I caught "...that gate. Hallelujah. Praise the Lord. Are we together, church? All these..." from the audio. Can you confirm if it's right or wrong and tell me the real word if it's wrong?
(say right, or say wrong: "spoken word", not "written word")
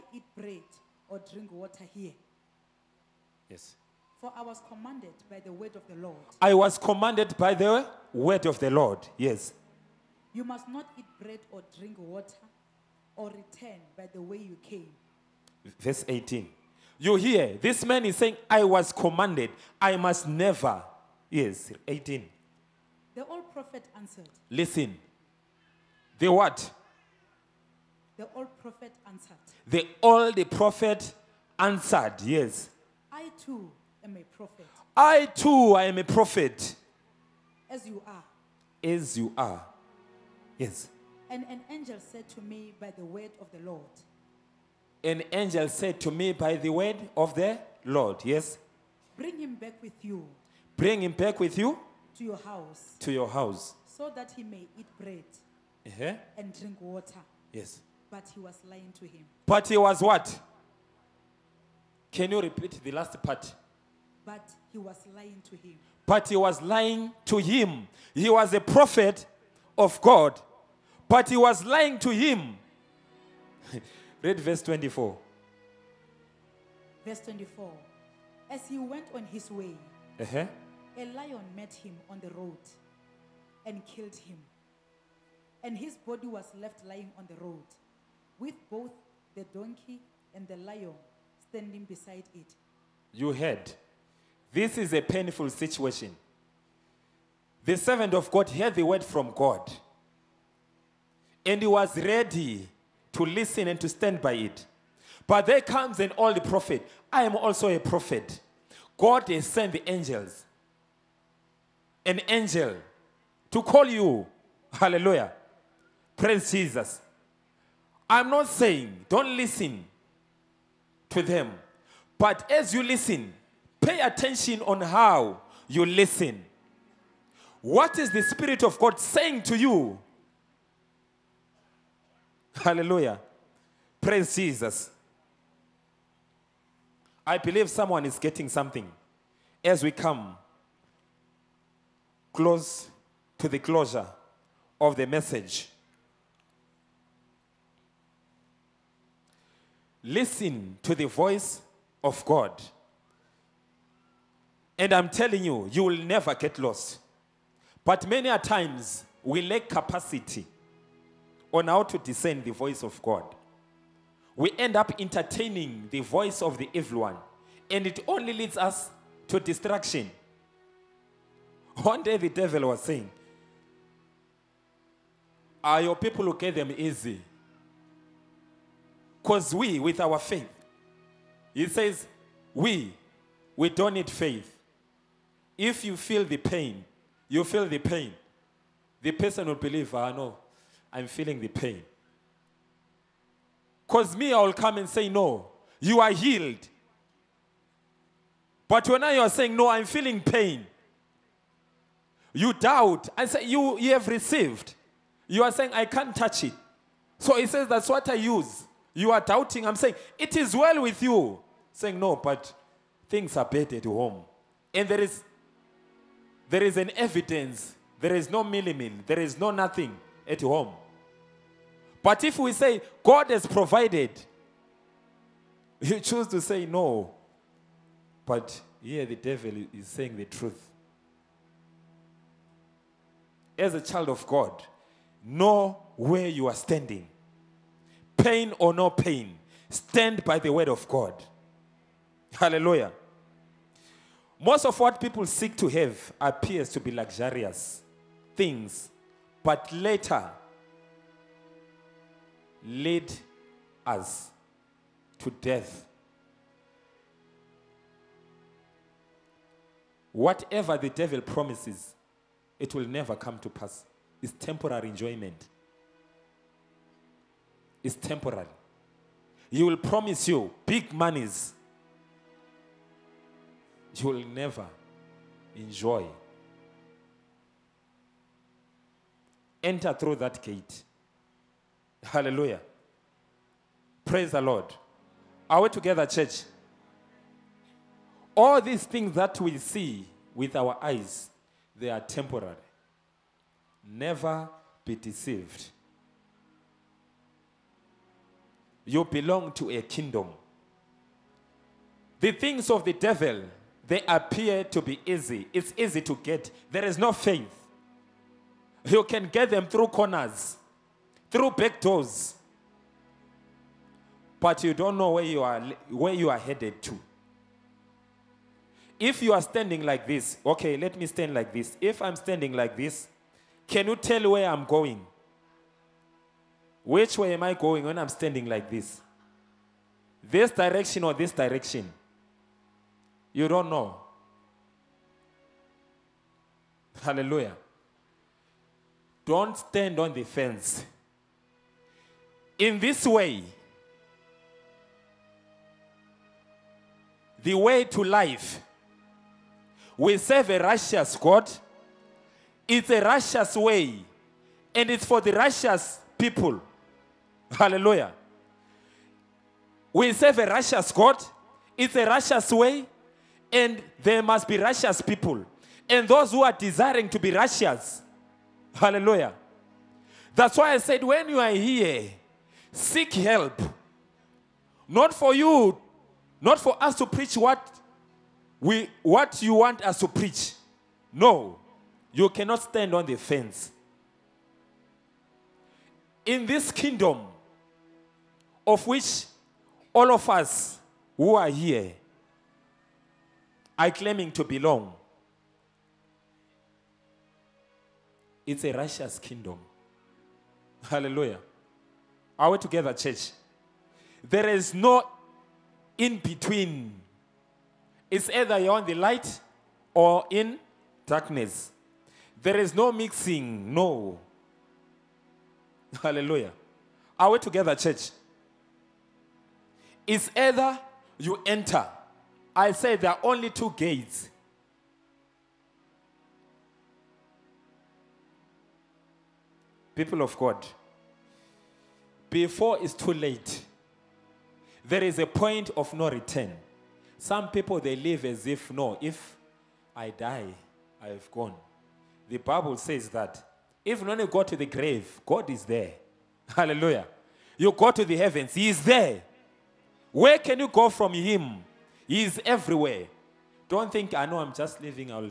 right.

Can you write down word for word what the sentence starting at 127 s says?
What is the Spirit of God saying to you?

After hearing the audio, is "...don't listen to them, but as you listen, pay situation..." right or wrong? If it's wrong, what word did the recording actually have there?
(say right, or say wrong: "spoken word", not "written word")
wrong: "attention", not "situation".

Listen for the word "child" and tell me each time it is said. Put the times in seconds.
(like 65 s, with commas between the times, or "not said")
233 s.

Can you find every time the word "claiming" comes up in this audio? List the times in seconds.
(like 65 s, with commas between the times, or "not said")
393 s.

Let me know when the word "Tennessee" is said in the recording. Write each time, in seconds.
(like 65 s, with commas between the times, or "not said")
not said.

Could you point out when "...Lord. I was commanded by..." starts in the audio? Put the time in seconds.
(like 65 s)
5 s.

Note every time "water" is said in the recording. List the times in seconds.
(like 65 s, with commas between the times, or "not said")
1 s, 11 s, 56 s.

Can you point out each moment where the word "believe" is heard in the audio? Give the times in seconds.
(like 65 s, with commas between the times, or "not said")
137 s, 189 s.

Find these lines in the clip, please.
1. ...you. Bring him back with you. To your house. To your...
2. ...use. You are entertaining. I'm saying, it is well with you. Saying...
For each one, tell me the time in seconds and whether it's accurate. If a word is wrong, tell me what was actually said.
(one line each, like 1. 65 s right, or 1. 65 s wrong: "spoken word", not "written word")
1. 50 s right
2. 208 s wrong: "doubting", not "entertaining".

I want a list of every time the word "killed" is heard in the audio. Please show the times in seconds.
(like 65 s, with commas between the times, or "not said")
83 s.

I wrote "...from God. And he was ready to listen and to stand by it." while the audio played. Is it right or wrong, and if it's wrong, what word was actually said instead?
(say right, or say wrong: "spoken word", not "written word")
right.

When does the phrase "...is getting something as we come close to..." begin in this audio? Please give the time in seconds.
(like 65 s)
138 s.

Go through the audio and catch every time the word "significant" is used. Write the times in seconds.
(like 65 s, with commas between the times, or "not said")
not said.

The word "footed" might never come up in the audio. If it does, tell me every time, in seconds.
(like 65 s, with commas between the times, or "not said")
not said.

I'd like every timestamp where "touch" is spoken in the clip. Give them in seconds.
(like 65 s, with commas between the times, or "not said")
206 s.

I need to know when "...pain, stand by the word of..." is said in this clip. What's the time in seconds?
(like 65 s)
238 s.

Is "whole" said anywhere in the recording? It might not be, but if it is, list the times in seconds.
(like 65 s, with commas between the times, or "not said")
not said.